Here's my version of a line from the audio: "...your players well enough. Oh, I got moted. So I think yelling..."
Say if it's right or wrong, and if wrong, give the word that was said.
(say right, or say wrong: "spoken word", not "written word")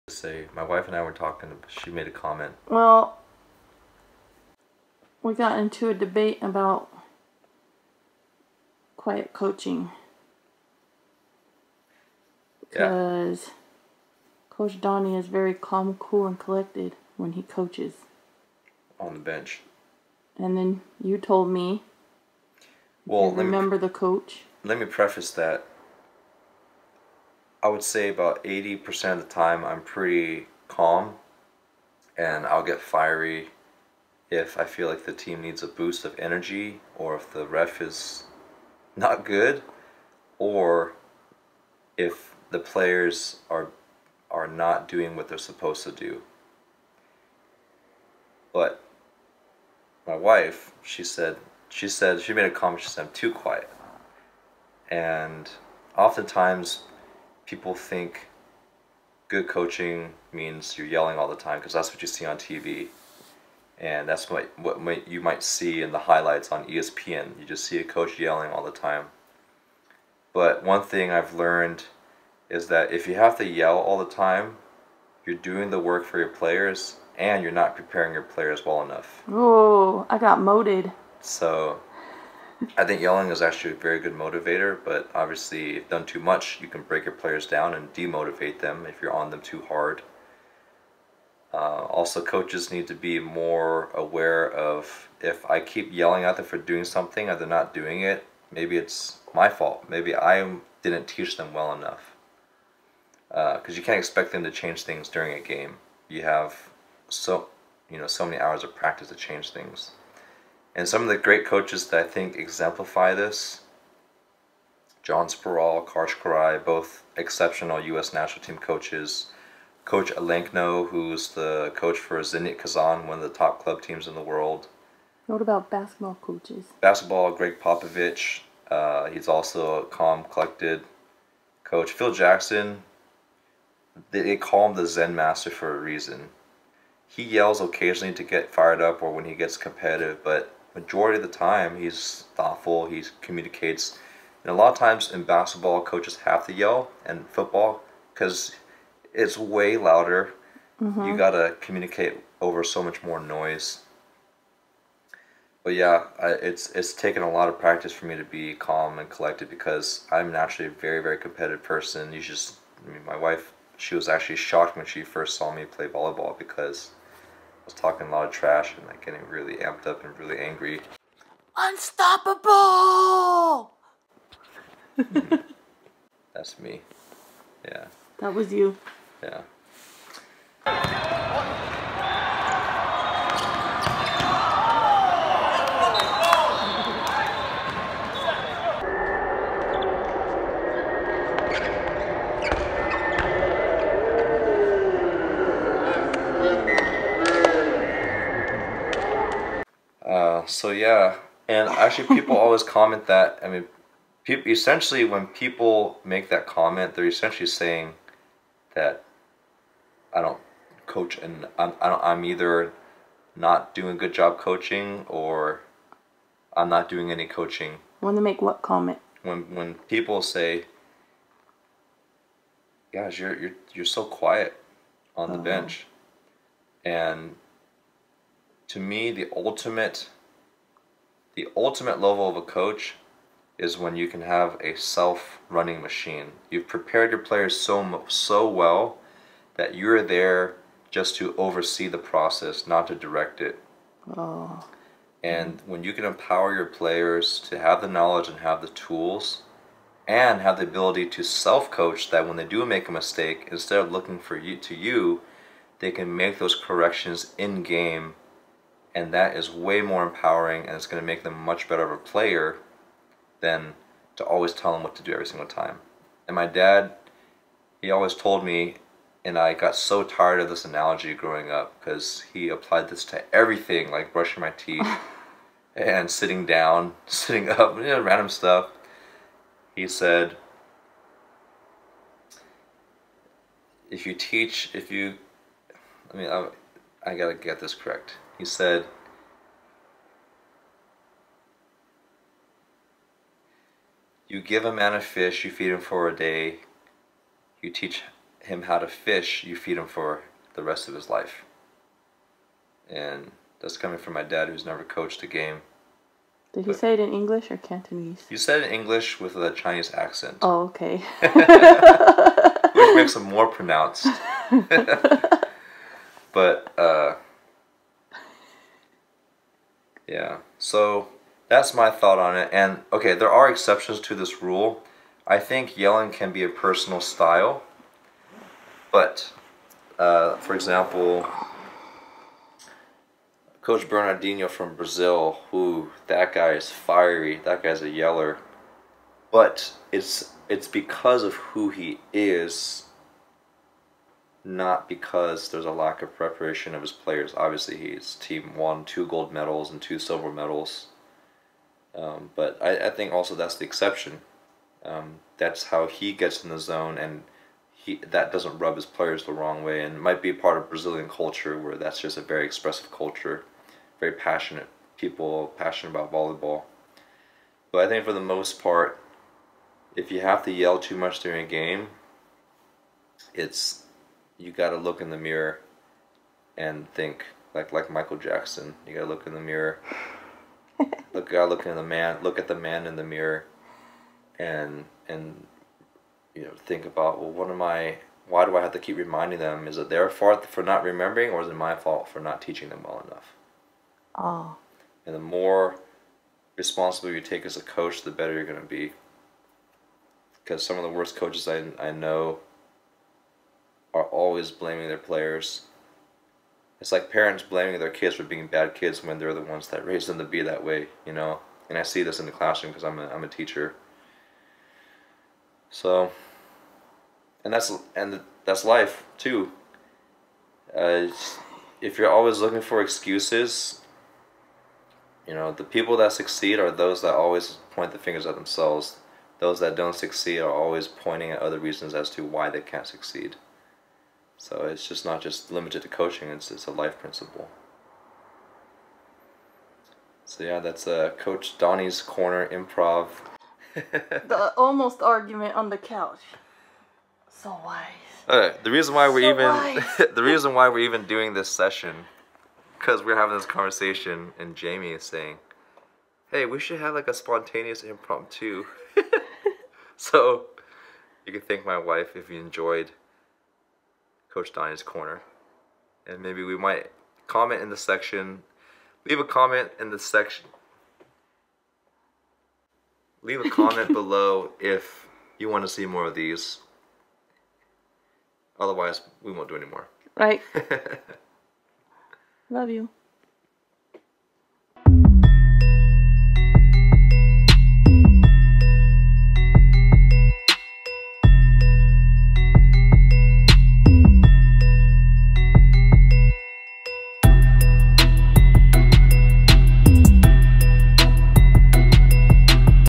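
right.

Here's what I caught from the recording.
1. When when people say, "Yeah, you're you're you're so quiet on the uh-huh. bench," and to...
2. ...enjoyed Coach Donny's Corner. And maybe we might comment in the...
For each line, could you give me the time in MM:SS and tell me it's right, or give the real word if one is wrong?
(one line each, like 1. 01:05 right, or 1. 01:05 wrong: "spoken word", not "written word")
1. 03:39 right
2. 07:42 right.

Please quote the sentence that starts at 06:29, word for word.
Is it their fault for not remembering, or is it my fault for not teaching them well enough?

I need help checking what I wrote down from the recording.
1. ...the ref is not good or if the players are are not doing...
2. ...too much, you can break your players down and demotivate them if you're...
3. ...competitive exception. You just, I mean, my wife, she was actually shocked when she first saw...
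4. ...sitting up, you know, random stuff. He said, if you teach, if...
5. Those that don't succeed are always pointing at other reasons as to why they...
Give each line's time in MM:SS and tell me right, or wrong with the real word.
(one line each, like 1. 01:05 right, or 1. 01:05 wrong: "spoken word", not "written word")
1. 00:37 right
2. 01:26 right
3. 02:41 wrong: "person", not "exception"
4. 04:37 right
5. 07:09 right.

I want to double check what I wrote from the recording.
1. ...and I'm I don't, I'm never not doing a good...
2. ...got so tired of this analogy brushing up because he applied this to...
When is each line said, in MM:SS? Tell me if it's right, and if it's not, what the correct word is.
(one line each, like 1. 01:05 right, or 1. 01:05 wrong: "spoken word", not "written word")
1. 03:31 wrong: "either", not "never"
2. 04:29 wrong: "growing", not "brushing".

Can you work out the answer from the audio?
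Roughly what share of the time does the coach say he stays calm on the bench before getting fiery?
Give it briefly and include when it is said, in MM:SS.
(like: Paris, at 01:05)
80%, at 00:28.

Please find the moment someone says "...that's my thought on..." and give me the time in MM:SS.
05:21.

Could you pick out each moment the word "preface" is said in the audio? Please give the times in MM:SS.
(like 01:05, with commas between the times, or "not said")
00:24.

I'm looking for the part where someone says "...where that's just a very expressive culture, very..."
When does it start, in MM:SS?
06:01.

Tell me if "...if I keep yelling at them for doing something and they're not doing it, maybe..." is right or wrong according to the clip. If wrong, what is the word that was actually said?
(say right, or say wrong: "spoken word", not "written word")
right.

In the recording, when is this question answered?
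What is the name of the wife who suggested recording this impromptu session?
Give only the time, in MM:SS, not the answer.
07:34.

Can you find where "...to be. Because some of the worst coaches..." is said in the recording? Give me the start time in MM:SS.
06:38.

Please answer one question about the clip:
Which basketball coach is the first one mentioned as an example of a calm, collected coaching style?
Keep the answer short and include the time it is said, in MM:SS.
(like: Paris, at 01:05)
Gregg Popovich, at 02:07.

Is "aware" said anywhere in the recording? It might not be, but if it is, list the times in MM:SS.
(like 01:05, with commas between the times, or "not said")
01:33.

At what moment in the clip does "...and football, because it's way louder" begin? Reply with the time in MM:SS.
02:27.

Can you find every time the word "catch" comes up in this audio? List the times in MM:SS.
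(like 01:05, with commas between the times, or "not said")
not said.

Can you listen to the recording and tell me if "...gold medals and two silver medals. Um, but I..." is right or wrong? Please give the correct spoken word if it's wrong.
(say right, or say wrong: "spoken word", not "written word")
right.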